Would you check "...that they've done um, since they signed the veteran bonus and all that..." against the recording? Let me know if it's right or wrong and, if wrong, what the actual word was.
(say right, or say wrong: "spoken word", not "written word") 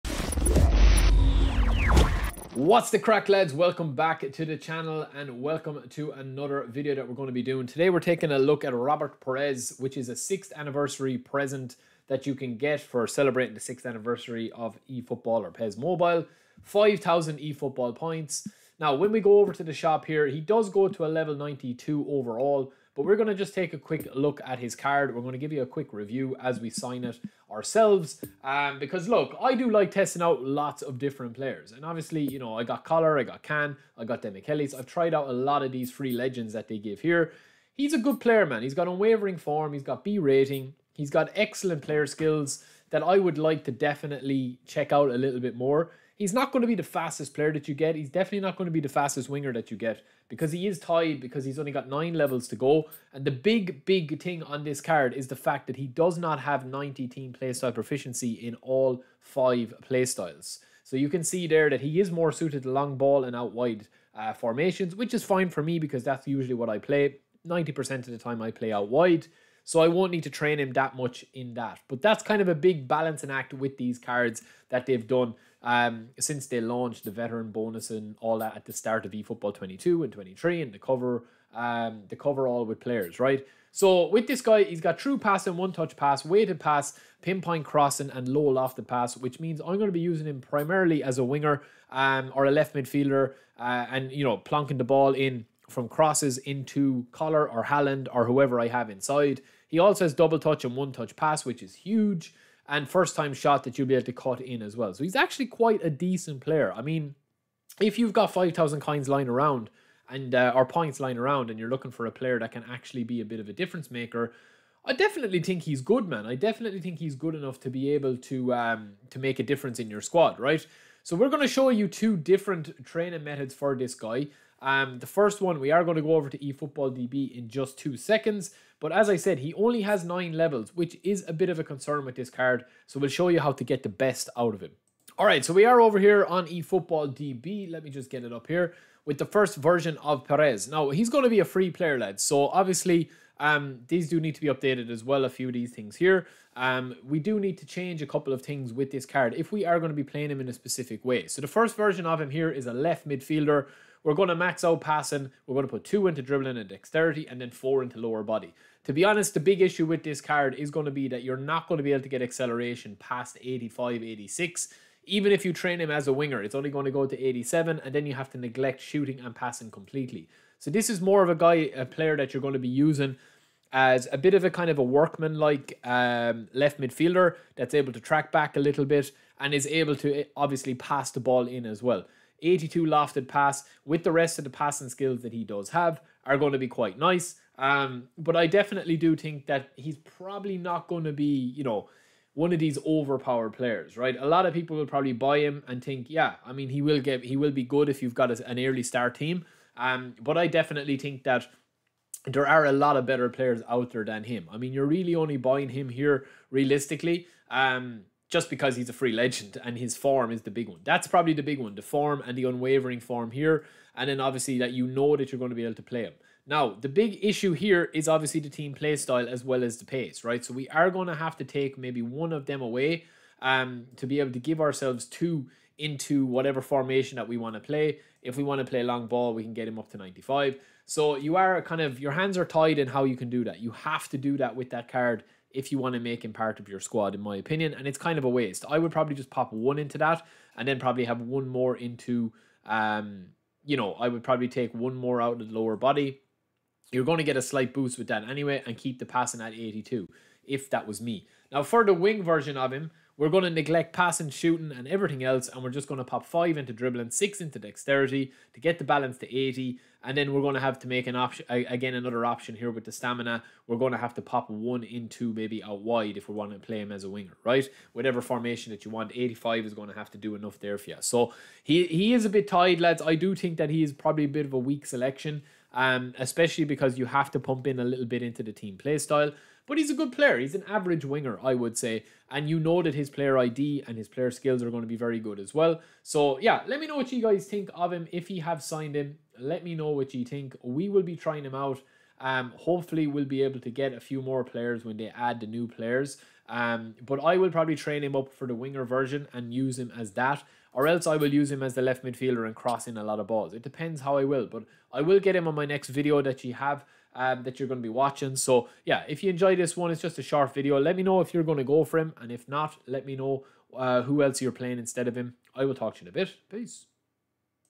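wrong: "launched", not "signed".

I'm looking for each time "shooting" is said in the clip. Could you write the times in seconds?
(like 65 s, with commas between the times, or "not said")
168 s, 254 s.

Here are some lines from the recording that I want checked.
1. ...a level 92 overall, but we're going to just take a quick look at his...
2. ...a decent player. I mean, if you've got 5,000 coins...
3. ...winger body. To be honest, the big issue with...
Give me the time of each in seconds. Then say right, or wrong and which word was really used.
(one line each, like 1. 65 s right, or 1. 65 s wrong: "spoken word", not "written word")
1. 21 s right
2. 105 s right
3. 157 s wrong: "lower", not "winger".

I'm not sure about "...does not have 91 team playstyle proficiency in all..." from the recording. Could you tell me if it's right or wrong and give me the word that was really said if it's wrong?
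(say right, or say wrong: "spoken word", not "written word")
wrong: "90", not "91".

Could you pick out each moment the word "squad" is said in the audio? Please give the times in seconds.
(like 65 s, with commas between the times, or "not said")
120 s, 236 s.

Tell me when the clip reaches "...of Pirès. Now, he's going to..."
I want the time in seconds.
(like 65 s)
139 s.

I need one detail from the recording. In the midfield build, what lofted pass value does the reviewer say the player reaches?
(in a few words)
82.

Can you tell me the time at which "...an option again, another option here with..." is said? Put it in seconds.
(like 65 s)
261 s.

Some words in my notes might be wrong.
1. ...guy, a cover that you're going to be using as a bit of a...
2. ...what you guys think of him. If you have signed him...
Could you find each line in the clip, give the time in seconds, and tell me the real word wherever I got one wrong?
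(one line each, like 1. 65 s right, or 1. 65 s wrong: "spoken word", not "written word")
1. 171 s wrong: "player", not "cover"
2. 286 s right.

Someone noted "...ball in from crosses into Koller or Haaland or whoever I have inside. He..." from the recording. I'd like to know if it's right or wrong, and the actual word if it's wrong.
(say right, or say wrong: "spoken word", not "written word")
right.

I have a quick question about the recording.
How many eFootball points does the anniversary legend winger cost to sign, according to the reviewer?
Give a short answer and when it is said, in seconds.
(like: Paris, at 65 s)
5,000, at 16 s.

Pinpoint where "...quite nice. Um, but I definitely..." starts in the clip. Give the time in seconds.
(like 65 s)
186 s.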